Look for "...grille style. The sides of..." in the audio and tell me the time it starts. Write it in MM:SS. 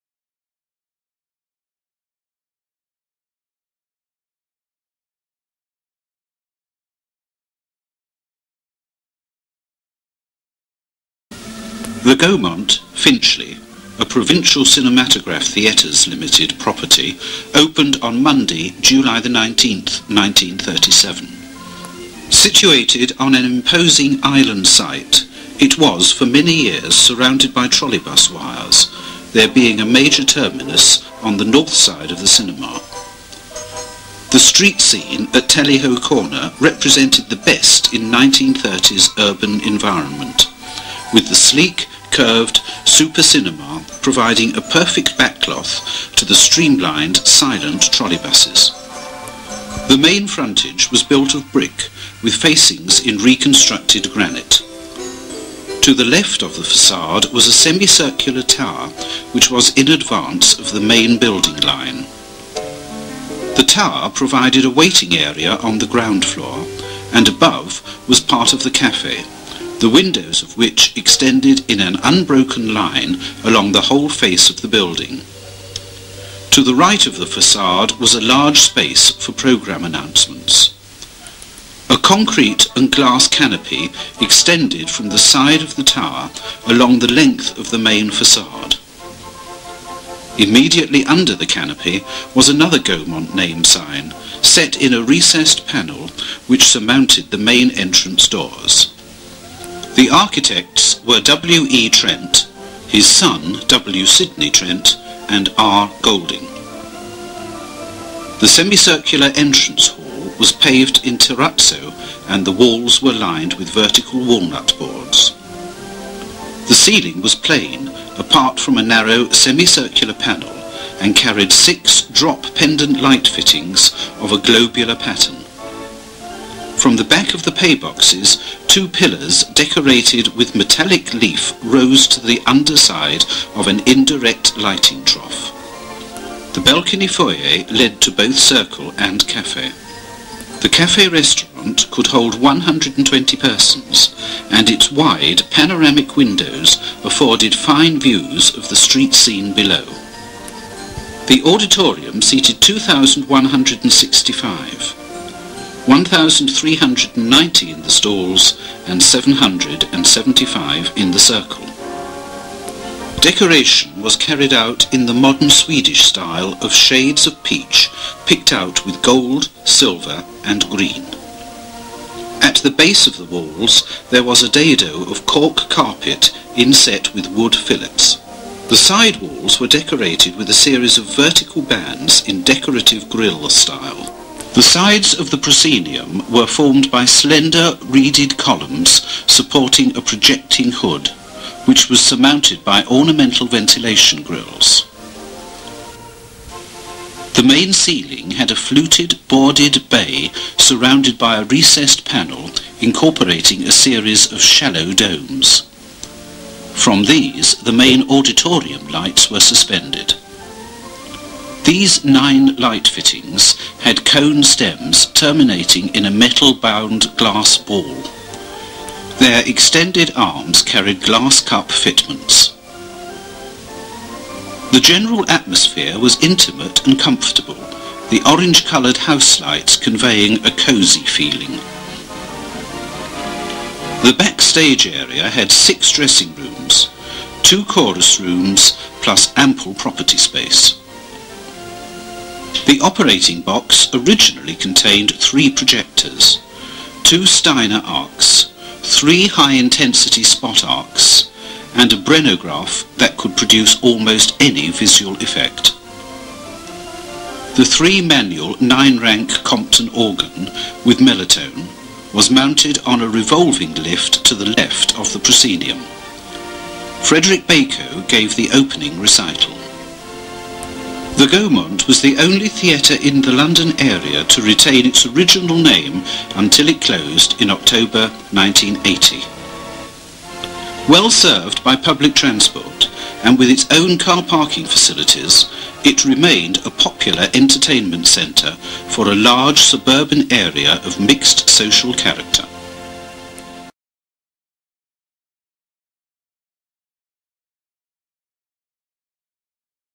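03:03.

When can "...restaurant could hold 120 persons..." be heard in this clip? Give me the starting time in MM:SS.
02:21.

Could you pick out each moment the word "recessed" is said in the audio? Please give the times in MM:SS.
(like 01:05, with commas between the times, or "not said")
01:35, 03:21.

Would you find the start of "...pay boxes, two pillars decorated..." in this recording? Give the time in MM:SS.
02:07.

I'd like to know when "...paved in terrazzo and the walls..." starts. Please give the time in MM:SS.
01:50.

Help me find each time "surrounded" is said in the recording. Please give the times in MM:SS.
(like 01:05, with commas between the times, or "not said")
00:26, 03:20.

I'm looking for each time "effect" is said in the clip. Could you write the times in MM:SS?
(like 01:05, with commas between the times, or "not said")
04:15.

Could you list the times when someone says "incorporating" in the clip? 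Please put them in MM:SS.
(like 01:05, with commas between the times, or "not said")
03:22.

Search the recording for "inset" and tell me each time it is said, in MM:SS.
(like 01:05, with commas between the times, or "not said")
02:56.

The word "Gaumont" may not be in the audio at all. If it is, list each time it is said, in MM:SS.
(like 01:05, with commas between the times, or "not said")
00:12, 01:32, 04:31.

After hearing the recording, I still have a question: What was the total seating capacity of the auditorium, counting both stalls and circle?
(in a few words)
2,165.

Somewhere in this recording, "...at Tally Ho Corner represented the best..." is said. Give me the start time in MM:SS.
00:35.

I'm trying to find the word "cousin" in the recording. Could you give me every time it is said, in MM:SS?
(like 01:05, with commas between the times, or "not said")
not said.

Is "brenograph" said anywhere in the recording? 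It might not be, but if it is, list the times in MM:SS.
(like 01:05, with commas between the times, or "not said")
04:11.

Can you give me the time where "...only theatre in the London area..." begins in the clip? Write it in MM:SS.
04:32.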